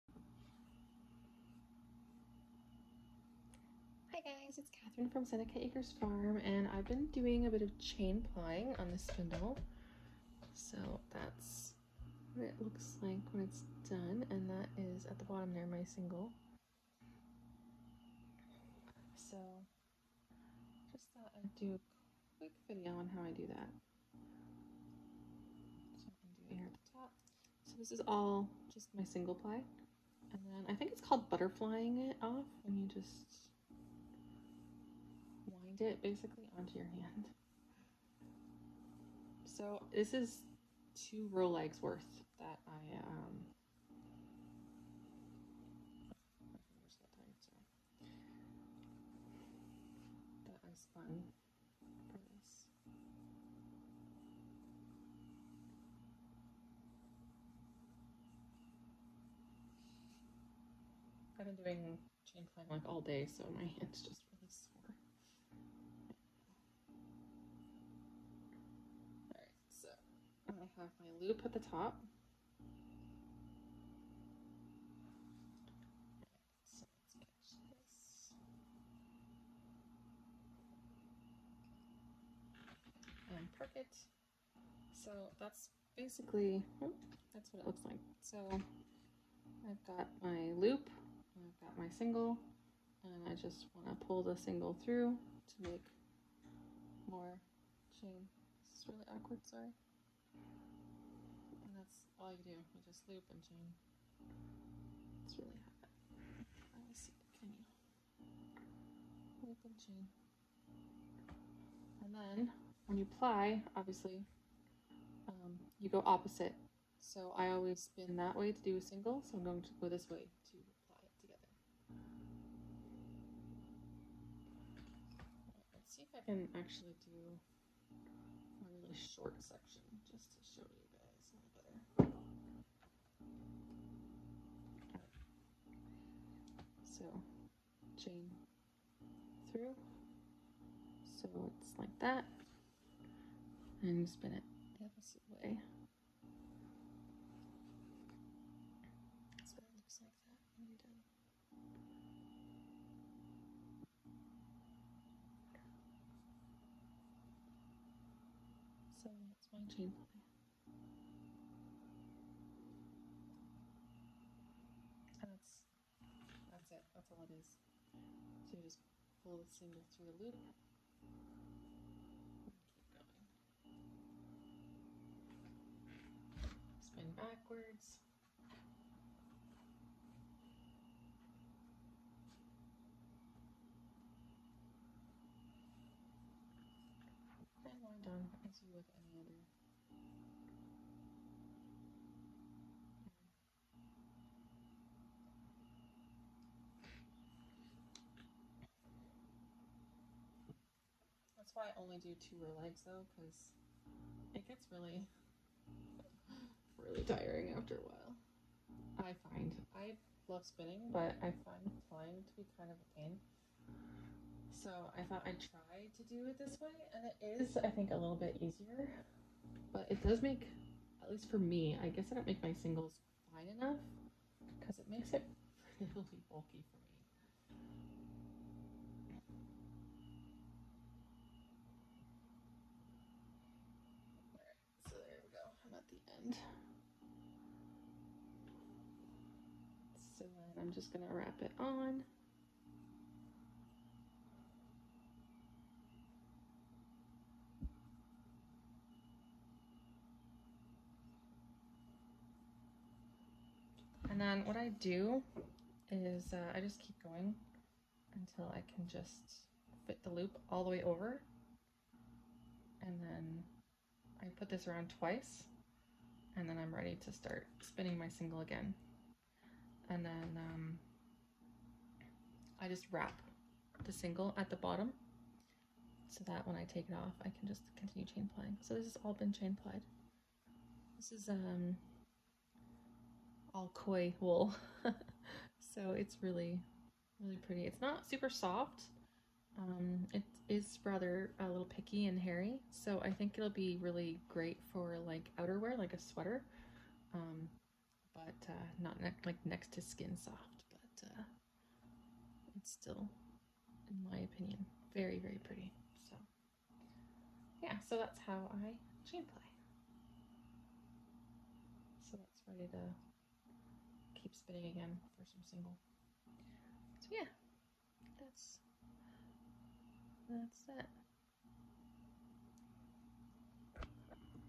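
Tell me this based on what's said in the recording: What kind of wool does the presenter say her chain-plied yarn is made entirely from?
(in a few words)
koi wool.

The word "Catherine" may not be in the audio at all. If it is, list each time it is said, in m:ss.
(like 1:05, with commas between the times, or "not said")
0:04.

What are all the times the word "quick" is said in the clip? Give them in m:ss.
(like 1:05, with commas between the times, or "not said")
0:22.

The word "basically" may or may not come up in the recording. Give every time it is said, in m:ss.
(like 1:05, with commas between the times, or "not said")
0:36, 1:25.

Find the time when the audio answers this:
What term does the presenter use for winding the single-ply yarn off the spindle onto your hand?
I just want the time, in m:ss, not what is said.
0:31.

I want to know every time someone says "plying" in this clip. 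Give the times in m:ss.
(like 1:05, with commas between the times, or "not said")
0:08, 1:02, 3:31, 4:38.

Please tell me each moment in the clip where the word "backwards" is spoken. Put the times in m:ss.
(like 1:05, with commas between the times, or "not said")
2:57.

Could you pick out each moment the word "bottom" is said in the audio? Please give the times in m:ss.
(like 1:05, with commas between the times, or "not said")
0:15, 4:34.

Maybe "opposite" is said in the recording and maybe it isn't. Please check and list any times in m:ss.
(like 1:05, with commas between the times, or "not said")
1:56, 2:24.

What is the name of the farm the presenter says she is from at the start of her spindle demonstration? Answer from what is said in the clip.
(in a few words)
Seneca Acres Farm.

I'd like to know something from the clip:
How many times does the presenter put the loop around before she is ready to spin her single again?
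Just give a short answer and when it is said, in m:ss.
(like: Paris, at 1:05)
twice, at 4:24.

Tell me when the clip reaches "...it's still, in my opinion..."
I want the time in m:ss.
5:02.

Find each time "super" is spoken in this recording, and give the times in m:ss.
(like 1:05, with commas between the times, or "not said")
4:48.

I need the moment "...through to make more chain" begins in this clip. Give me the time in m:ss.
1:34.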